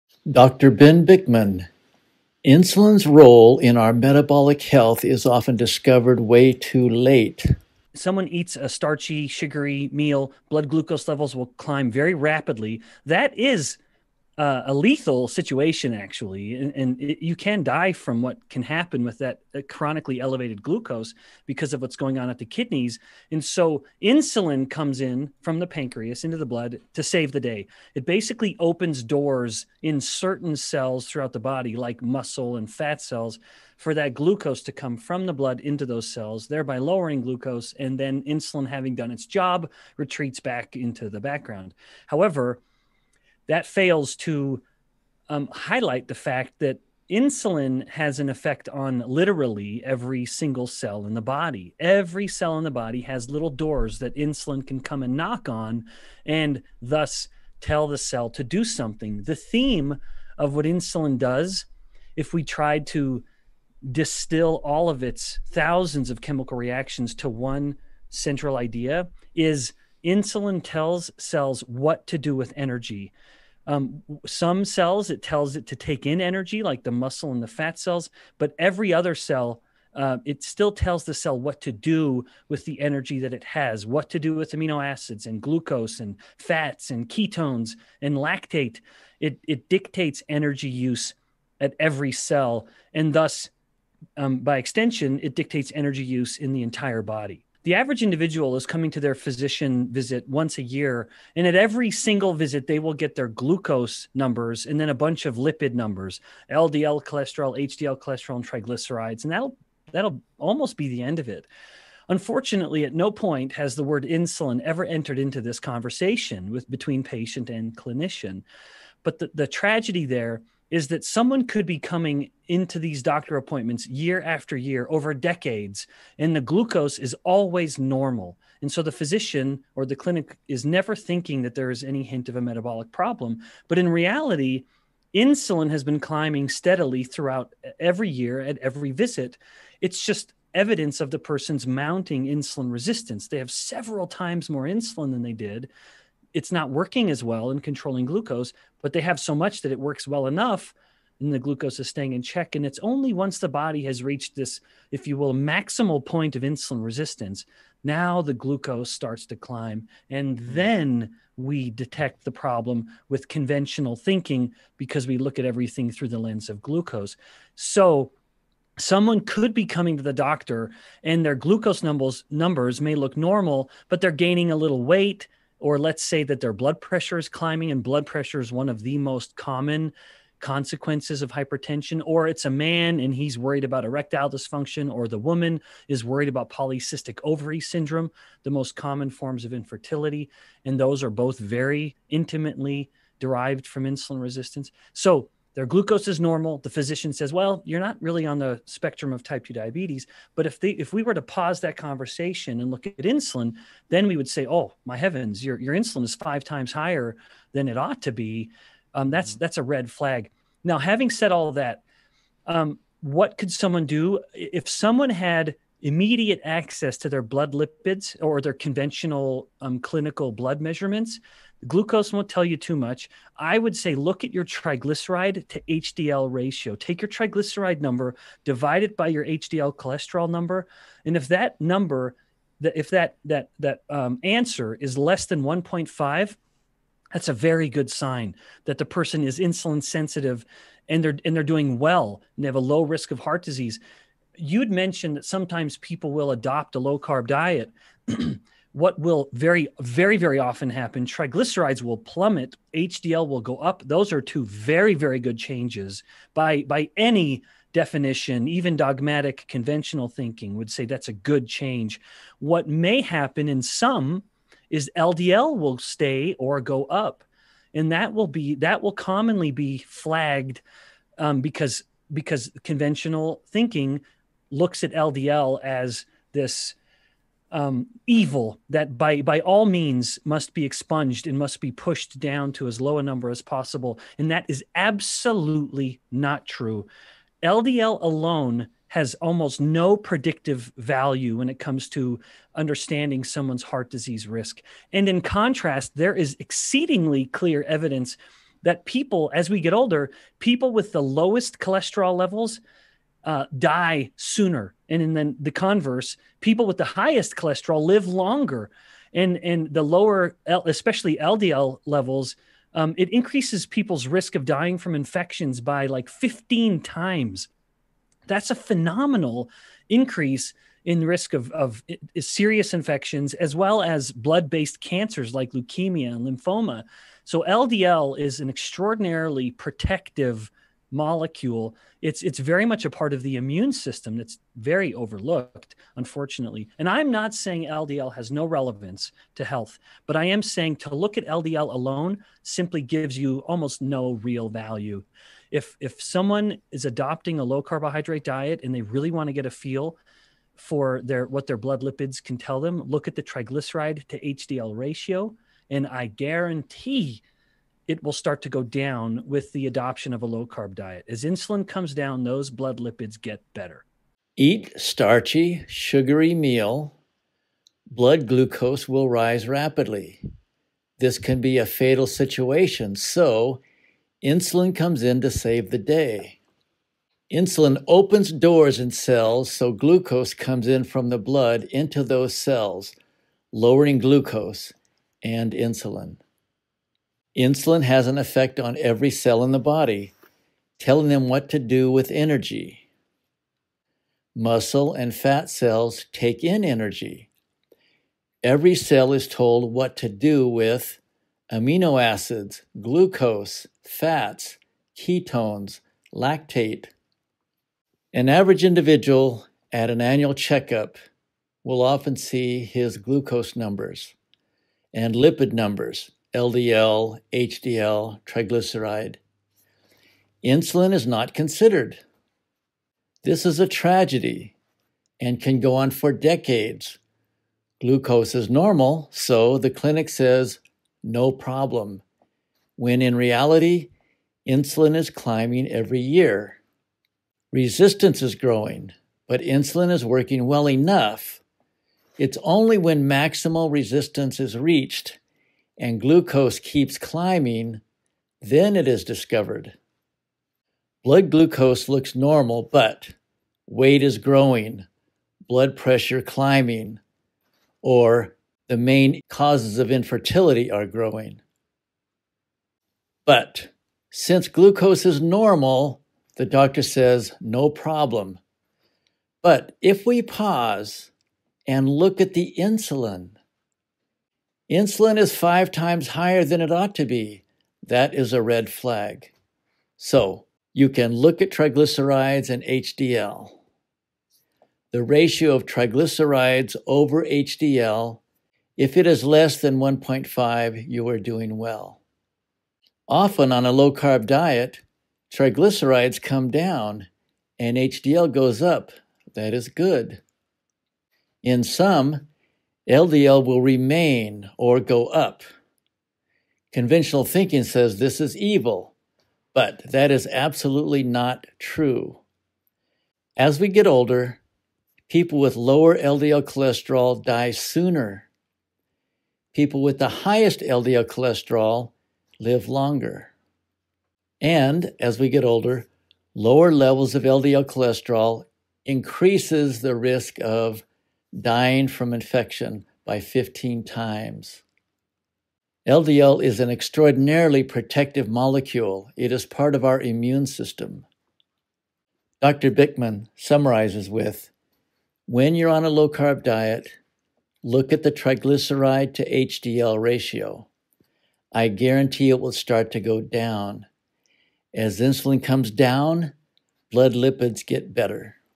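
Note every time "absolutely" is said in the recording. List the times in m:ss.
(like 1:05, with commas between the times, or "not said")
4:44, 8:30.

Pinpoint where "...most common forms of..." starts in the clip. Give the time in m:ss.
3:08.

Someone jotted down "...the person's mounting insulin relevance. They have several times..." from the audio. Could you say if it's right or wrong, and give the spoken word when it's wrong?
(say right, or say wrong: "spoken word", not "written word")
wrong: "resistance", not "relevance".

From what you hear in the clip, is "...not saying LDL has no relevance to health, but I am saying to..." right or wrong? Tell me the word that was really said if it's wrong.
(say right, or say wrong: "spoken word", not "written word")
right.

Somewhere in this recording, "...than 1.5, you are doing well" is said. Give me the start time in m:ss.
8:09.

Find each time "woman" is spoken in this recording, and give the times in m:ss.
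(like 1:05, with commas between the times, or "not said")
3:05.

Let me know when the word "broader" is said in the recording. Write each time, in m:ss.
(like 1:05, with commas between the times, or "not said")
not said.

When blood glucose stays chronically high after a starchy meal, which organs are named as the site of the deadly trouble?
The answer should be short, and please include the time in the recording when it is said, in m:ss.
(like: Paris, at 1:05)
kidneys, at 0:22.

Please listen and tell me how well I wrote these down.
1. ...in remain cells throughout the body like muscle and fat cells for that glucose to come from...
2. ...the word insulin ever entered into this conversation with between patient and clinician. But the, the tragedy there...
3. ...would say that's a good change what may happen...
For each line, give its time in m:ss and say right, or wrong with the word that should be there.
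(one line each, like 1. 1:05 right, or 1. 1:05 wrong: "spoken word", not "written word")
1. 0:29 wrong: "certain", not "remain"
2. 1:53 right
3. 4:20 right.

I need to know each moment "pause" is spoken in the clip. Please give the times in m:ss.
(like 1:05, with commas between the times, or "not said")
3:21, 7:50.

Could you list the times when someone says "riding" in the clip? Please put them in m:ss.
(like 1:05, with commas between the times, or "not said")
not said.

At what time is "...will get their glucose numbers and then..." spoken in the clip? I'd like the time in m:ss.
1:42.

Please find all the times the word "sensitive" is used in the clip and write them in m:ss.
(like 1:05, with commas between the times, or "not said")
3:59.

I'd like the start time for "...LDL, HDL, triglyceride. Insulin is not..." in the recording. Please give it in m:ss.
6:56.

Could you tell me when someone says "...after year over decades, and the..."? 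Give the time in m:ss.
2:04.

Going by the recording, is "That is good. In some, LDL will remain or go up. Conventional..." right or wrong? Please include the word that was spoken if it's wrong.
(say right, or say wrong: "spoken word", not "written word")
right.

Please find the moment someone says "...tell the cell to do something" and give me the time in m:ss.
0:57.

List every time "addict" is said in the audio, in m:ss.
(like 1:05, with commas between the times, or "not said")
not said.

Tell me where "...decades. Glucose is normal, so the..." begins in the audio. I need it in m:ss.
7:06.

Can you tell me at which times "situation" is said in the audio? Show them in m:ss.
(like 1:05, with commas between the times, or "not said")
0:15, 6:12.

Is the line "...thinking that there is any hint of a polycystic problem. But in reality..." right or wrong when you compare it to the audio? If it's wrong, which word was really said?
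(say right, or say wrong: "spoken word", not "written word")
wrong: "metabolic", not "polycystic".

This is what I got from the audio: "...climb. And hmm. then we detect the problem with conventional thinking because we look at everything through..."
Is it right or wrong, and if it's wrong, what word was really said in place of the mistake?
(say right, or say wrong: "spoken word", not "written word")
right.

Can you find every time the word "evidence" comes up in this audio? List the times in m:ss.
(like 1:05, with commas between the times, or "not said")
2:20, 4:57.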